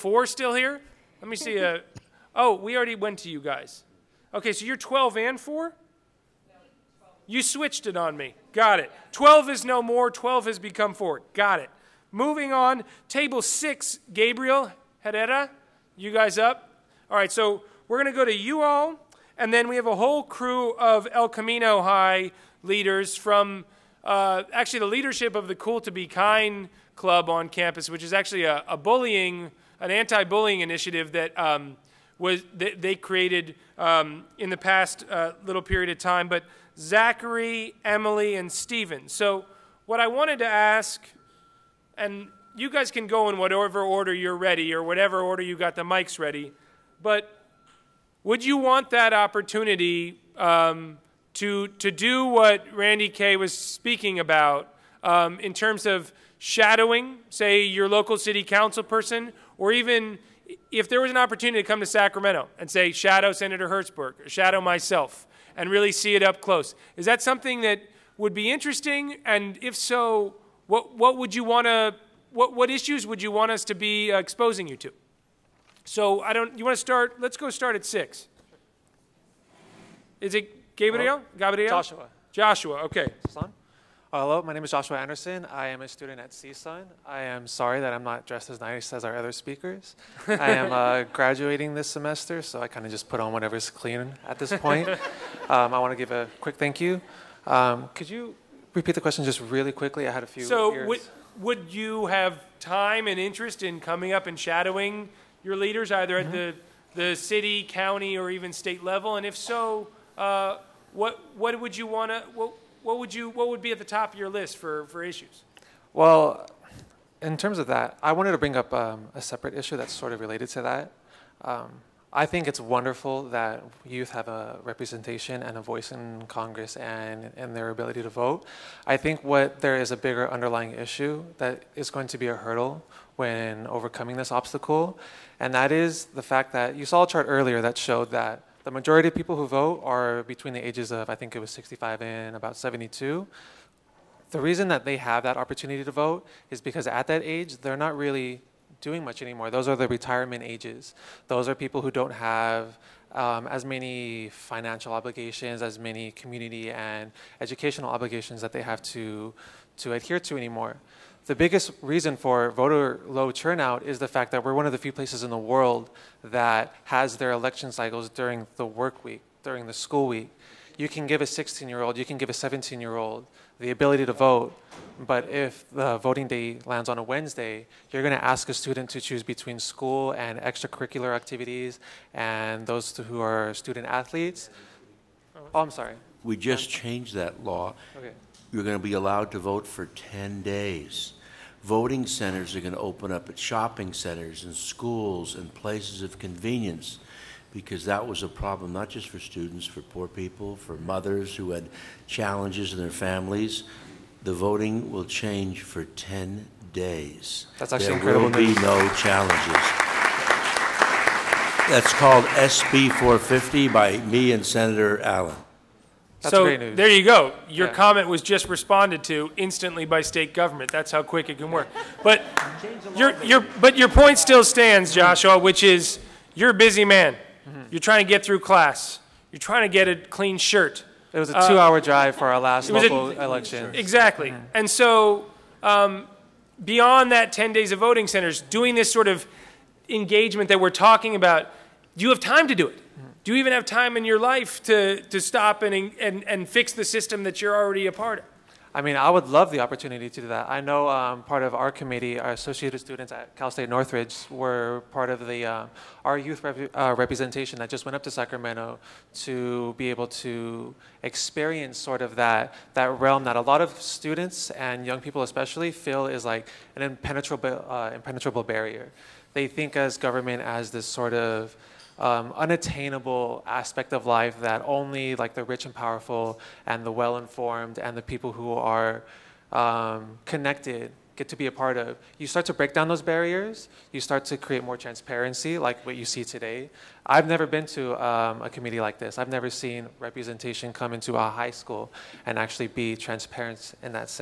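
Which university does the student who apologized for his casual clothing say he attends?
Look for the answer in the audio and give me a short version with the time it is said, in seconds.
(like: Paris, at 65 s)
CSUN, at 86 s.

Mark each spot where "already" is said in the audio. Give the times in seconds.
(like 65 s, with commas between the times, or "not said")
2 s, 247 s.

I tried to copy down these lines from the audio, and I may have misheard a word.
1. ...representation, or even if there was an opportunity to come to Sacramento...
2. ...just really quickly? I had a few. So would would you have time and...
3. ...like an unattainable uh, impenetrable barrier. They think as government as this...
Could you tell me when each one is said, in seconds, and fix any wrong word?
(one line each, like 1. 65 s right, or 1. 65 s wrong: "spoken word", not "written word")
1. 58 s wrong: "person", not "representation"
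2. 99 s right
3. 266 s wrong: "impenetrable", not "unattainable".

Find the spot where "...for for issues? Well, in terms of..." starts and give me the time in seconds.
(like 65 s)
114 s.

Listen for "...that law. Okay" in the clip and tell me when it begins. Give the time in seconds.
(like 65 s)
187 s.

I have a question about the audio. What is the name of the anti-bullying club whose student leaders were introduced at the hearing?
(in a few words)
Cool to Be Kind Club.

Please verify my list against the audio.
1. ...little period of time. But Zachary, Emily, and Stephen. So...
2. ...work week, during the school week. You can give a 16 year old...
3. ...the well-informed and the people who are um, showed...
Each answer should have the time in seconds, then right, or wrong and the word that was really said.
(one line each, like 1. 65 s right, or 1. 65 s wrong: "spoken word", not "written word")
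1. 35 s right
2. 168 s right
3. 276 s wrong: "connected", not "showed".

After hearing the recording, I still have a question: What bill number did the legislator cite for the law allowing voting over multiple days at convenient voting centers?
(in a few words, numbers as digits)
SB 450.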